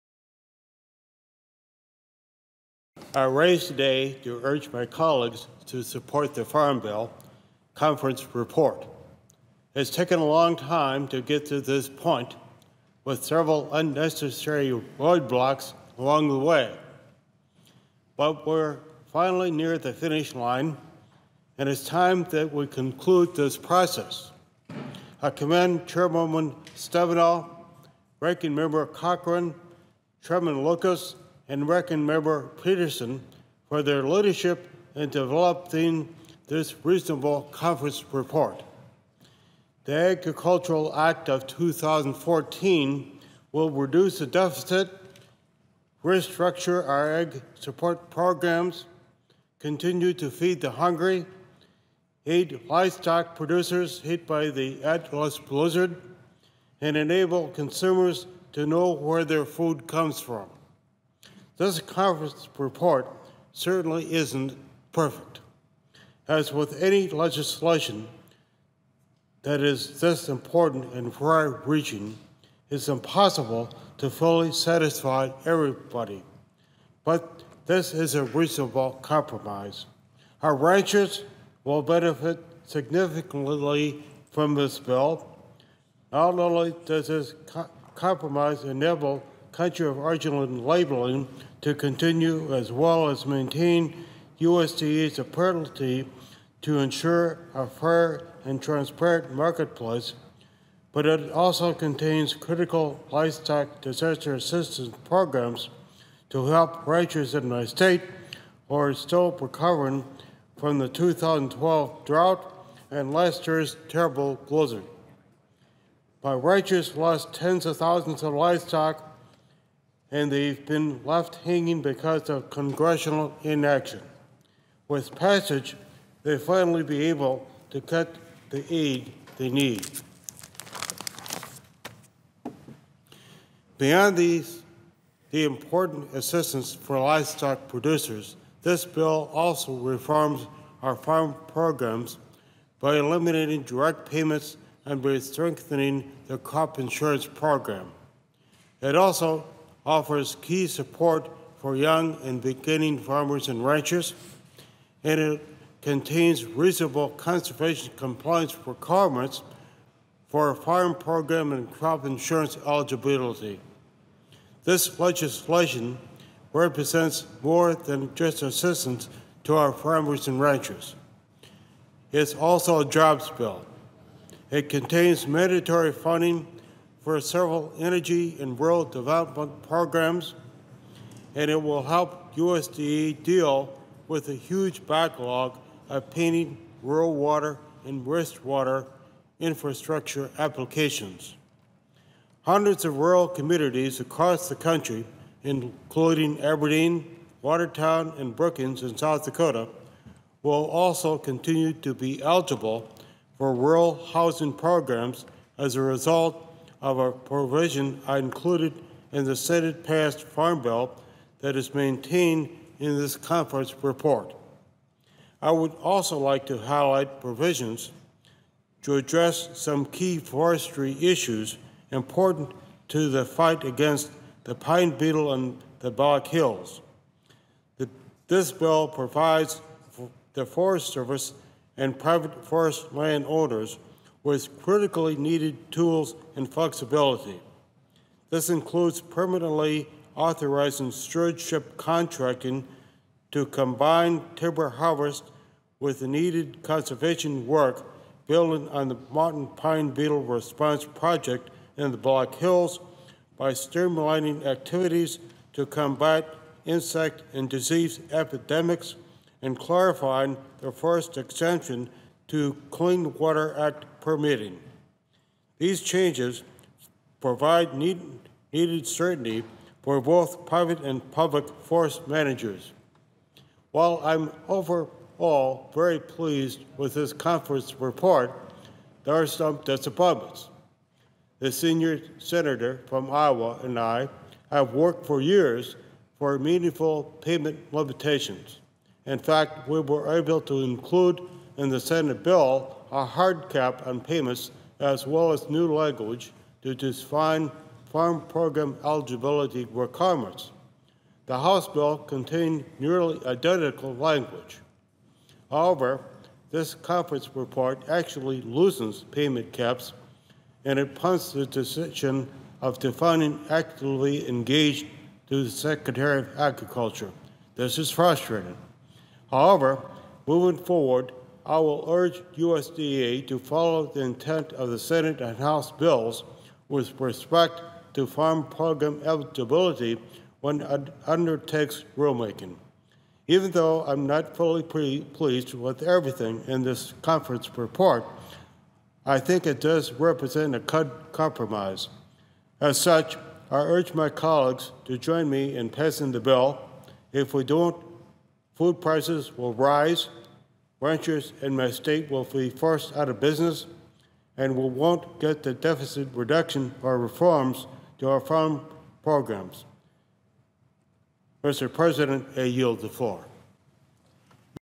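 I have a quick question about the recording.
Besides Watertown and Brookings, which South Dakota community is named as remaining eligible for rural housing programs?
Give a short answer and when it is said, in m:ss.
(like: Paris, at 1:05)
Aberdeen, at 3:16.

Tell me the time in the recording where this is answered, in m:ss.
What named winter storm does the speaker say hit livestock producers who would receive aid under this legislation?
0:54.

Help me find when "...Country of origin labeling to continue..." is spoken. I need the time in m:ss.
1:29.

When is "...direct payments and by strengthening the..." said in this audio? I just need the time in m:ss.
2:23.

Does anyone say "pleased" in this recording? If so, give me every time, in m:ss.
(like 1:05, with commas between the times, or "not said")
4:35, 5:34.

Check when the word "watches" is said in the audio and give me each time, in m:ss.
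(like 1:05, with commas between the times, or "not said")
not said.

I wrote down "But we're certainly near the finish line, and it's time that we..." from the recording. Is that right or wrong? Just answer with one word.
wrong.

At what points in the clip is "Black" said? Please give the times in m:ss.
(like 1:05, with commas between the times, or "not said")
3:45, 4:11.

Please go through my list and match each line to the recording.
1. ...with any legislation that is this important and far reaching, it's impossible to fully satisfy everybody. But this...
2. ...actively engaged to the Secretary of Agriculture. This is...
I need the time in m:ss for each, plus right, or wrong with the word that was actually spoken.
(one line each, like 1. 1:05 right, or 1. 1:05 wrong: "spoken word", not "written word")
1. 1:06 right
2. 5:13 right.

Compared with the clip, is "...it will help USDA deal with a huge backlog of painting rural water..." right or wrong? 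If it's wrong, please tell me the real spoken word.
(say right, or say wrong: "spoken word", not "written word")
right.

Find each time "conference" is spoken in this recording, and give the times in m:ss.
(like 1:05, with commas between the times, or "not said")
0:07, 0:37, 1:01, 3:33, 4:37, 5:06, 5:37.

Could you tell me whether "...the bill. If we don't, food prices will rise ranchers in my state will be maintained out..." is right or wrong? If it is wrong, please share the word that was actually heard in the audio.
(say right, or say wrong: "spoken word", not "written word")
wrong: "forced", not "maintained".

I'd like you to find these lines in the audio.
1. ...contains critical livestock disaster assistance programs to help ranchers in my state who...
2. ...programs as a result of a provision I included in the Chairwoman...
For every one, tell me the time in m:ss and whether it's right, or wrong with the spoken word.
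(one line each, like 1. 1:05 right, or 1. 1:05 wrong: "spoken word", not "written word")
1. 1:41 right
2. 3:24 wrong: "Senate", not "Chairwoman".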